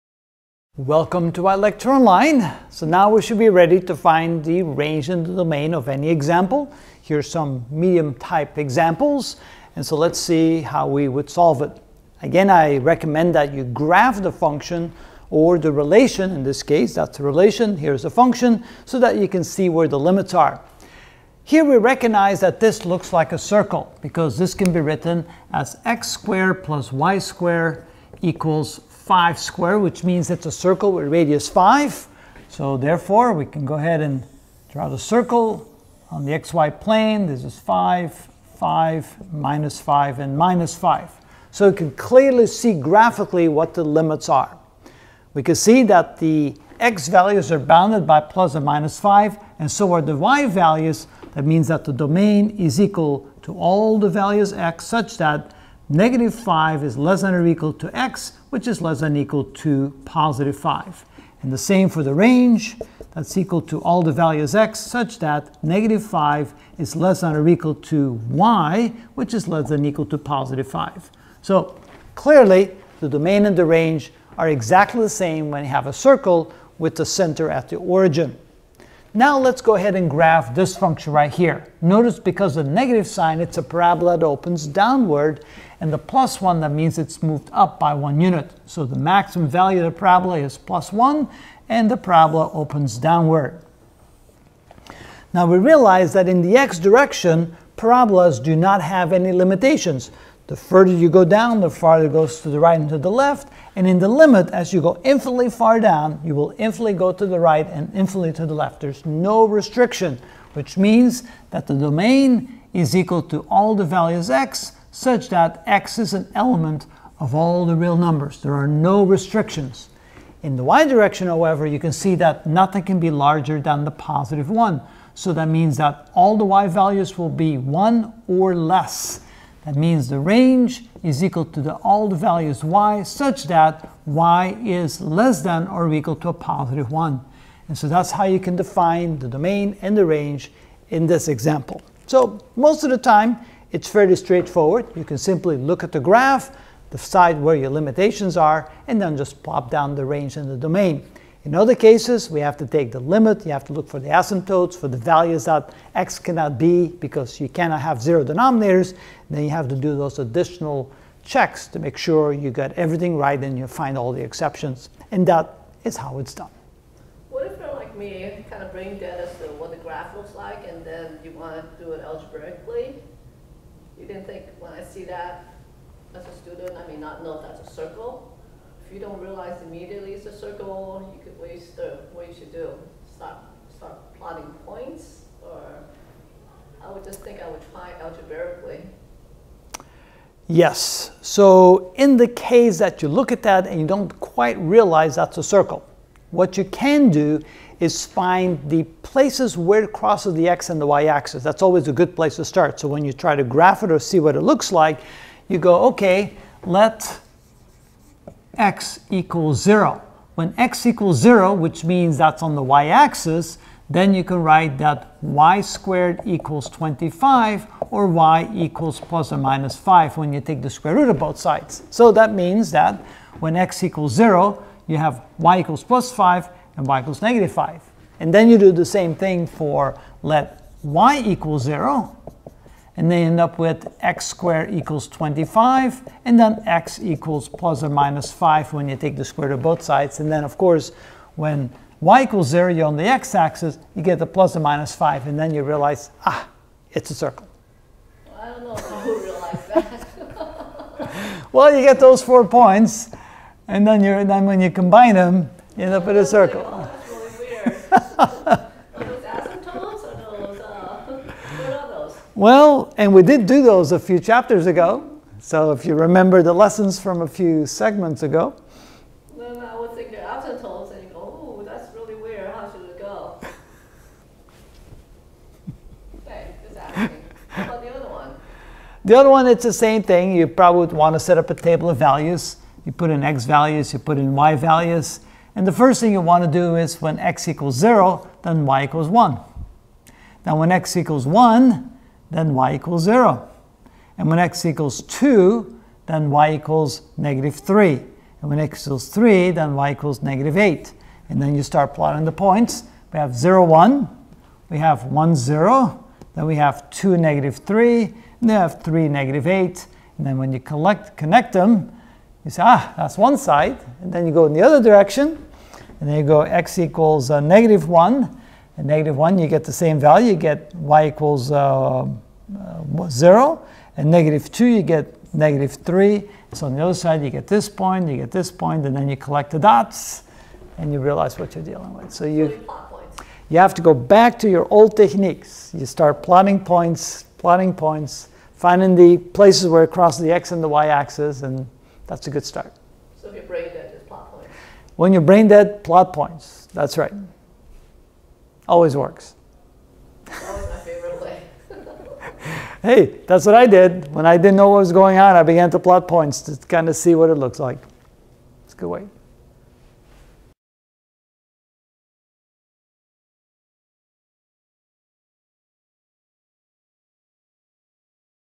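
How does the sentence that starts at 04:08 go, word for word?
Well, I don't know how you realize that.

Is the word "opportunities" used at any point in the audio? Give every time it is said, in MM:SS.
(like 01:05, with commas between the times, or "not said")
not said.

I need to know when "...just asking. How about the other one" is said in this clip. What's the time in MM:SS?
04:36.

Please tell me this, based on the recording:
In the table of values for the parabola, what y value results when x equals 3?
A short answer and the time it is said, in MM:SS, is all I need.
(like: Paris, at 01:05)
-8, at 04:59.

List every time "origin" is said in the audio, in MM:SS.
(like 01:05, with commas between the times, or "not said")
01:17.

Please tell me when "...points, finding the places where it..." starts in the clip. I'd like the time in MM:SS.
05:37.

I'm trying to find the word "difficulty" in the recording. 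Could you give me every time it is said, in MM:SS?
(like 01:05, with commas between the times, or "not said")
not said.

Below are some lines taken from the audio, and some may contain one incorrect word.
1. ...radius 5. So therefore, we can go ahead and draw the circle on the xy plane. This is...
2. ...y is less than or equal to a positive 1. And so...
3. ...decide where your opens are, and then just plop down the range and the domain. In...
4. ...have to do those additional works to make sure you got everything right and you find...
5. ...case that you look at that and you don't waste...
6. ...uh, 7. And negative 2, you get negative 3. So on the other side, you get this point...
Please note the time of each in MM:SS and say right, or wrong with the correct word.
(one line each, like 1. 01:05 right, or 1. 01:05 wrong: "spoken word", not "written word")
1. 00:31 right
2. 02:14 right
3. 02:26 wrong: "limitations", not "opens"
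4. 02:39 wrong: "checks", not "works"
5. 03:12 wrong: "quite", not "waste"
6. 05:22 wrong: "0", not "7".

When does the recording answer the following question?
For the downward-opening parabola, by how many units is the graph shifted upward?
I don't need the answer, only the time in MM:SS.
01:27.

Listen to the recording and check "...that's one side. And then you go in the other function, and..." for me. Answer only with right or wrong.
wrong.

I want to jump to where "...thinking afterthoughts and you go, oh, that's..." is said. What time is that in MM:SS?
04:29.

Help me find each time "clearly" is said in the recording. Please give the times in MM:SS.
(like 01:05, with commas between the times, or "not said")
00:41, 01:12.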